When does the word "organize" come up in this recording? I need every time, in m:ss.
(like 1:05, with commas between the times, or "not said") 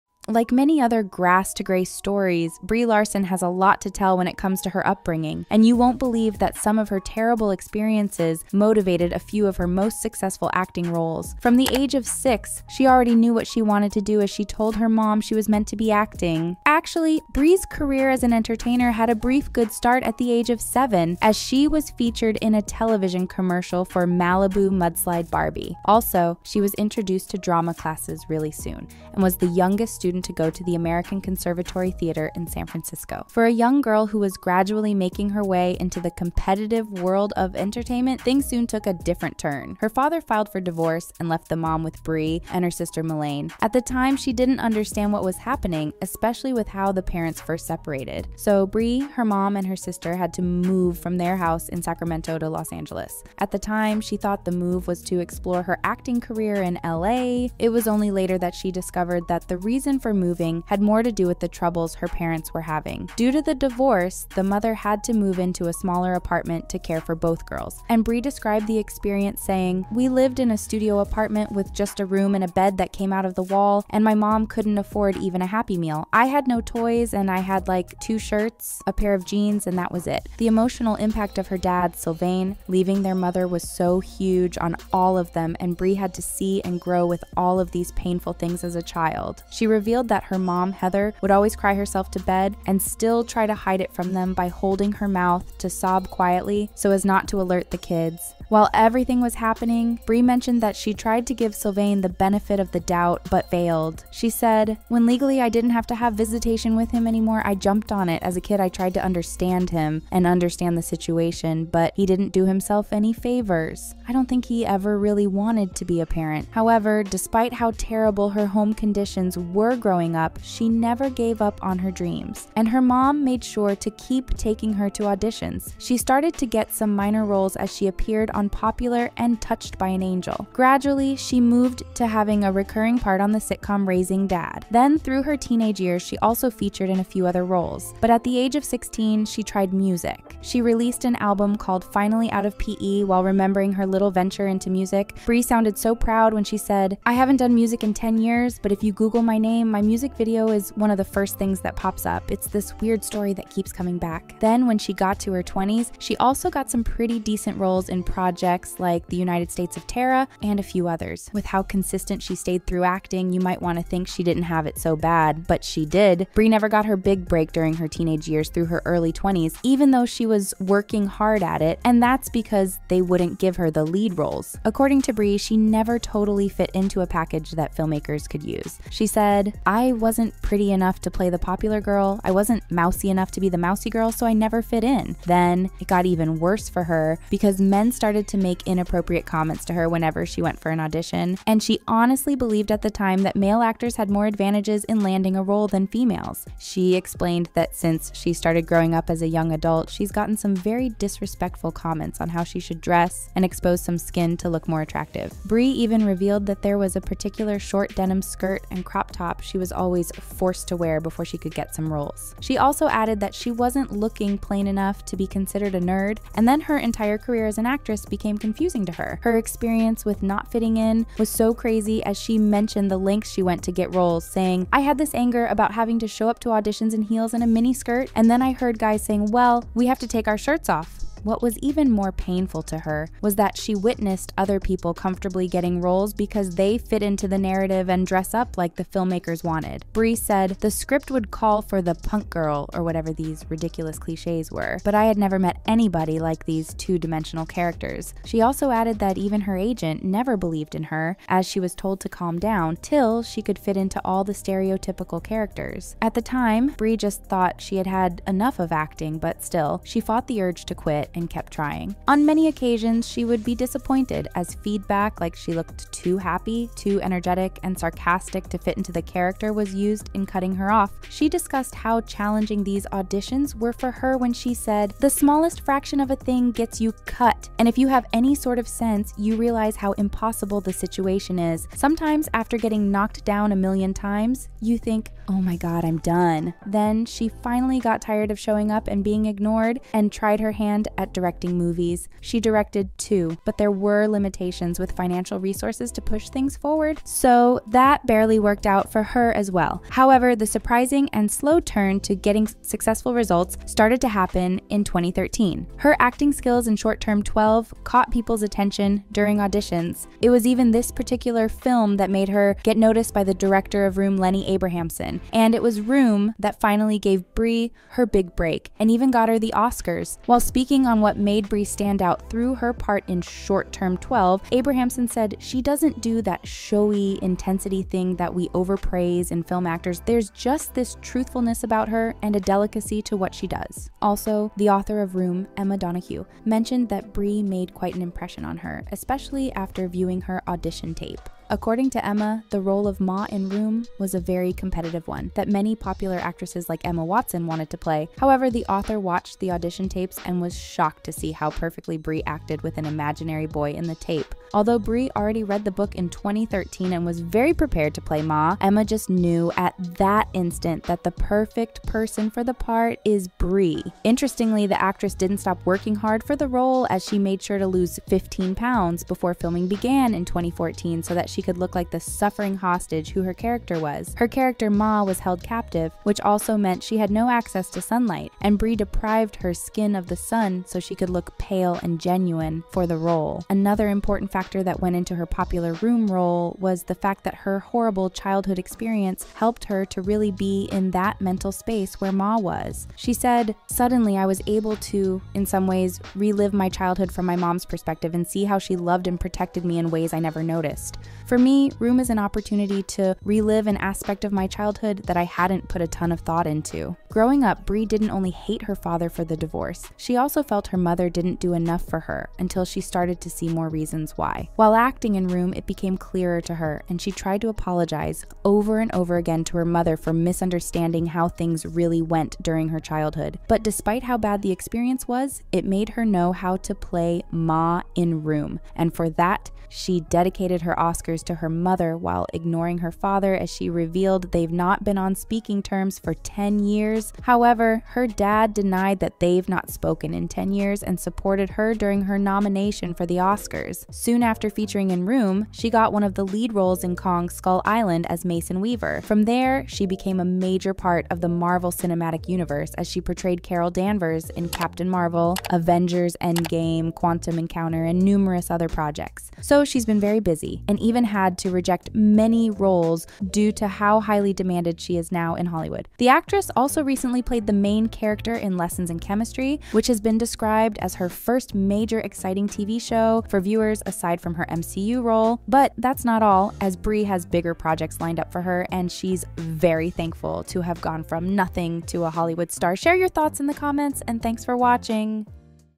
not said.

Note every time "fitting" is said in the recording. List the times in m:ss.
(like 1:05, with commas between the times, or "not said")
3:40.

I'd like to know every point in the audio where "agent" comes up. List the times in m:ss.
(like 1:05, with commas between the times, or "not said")
4:09.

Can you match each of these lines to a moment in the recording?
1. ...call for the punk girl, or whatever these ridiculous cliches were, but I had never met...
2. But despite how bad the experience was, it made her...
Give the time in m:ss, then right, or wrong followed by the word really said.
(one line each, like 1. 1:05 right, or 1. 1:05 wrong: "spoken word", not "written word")
1. 4:01 right
2. 7:03 right.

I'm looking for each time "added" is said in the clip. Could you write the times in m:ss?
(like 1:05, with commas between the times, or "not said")
3:32, 4:08.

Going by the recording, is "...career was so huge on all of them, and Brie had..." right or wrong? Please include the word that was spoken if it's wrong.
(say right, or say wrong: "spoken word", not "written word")
wrong: "mother", not "career".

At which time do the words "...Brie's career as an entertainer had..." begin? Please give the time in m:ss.
0:17.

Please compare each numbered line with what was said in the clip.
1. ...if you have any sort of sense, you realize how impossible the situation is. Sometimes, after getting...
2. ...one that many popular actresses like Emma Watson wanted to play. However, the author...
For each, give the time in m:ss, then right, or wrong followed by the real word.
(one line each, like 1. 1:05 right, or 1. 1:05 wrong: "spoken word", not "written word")
1. 4:37 right
2. 5:45 right.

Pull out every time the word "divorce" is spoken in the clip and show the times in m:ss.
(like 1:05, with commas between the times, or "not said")
0:40, 1:03, 6:49.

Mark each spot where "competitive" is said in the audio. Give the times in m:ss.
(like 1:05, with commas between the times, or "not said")
0:36, 5:44.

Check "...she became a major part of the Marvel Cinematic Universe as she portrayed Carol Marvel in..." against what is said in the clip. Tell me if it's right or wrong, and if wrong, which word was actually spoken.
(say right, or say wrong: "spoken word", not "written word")
wrong: "Danvers", not "Marvel".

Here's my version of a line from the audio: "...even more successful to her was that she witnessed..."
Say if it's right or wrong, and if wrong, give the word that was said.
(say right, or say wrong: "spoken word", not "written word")
wrong: "painful", not "successful".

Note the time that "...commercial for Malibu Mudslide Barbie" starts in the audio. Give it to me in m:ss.
0:23.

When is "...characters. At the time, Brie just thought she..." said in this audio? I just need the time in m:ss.
4:15.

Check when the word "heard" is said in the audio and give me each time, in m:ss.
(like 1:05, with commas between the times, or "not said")
3:48.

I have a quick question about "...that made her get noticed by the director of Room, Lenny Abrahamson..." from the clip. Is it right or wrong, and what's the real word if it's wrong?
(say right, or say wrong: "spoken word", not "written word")
right.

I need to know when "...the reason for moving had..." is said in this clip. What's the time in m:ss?
0:59.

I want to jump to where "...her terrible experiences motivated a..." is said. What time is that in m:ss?
0:06.